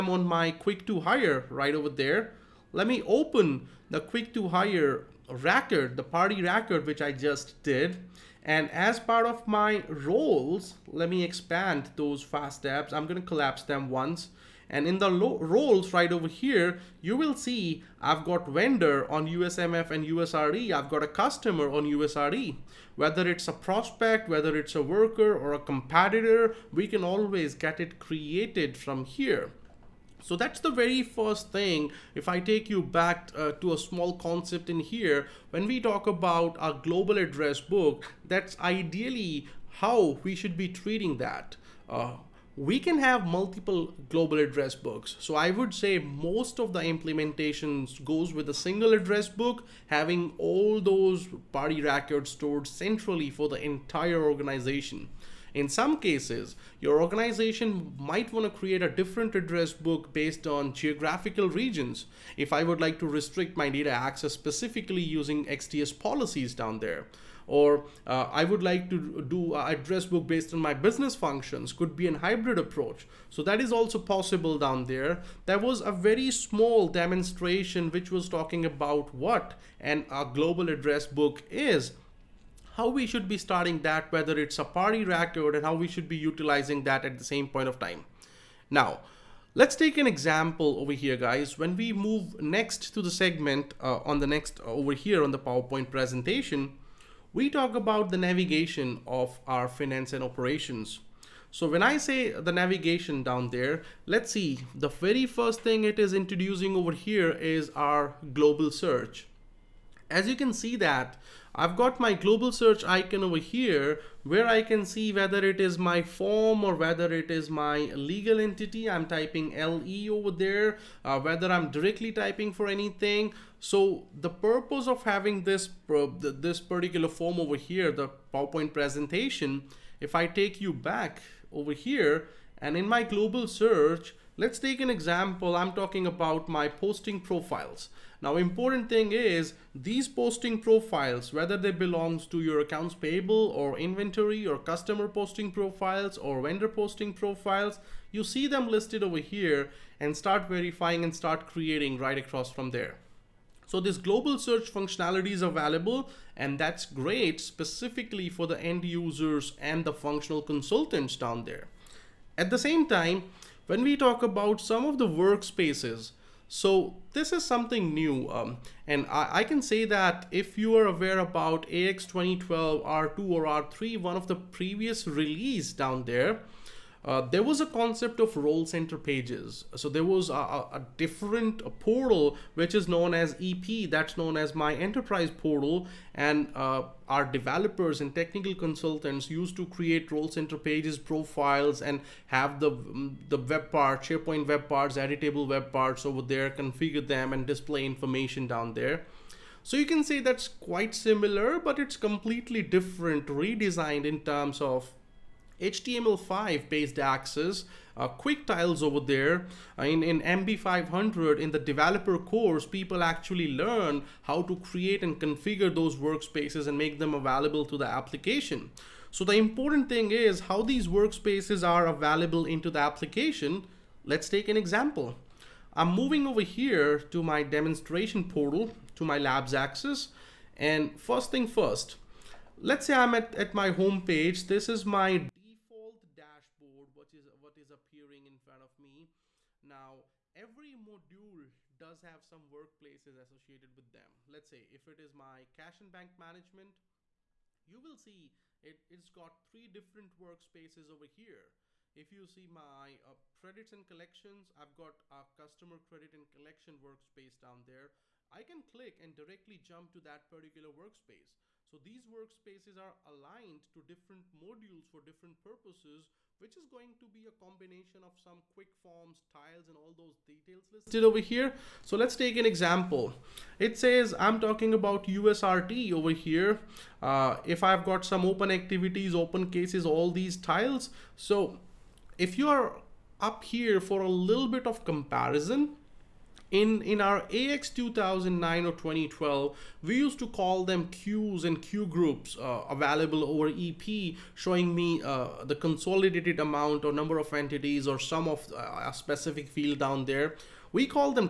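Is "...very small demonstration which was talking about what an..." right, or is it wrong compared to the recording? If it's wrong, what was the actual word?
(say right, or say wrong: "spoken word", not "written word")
right.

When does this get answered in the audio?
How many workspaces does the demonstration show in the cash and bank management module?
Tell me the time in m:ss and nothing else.
4:09.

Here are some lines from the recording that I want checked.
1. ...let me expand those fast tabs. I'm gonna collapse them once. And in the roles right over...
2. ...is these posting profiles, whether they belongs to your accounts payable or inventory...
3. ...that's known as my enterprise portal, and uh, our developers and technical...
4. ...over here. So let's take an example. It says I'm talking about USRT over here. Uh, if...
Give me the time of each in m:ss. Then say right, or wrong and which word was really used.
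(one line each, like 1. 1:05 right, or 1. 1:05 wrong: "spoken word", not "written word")
1. 0:10 right
2. 2:19 right
3. 3:03 right
4. 4:31 right.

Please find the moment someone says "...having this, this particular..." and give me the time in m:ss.
2:05.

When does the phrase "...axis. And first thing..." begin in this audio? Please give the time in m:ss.
3:49.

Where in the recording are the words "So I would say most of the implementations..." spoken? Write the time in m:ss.
0:45.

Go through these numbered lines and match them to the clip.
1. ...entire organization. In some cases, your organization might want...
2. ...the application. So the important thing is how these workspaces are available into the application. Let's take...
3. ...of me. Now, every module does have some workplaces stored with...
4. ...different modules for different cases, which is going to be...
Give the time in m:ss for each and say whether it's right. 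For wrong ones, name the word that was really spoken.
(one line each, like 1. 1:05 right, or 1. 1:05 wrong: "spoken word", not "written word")
1. 0:53 right
2. 3:37 right
3. 3:58 wrong: "associated", not "stored"
4. 4:23 wrong: "purposes", not "cases".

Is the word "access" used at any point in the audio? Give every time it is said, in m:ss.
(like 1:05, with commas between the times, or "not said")
1:03, 3:26.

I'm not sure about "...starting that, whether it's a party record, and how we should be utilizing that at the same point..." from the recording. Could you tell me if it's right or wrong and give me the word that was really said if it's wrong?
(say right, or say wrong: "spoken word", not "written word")
right.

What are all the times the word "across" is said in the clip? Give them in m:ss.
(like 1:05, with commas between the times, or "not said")
2:32.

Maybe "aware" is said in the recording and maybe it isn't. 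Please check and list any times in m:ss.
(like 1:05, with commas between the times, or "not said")
2:50.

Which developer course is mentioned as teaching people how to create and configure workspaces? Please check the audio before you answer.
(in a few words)
MB500.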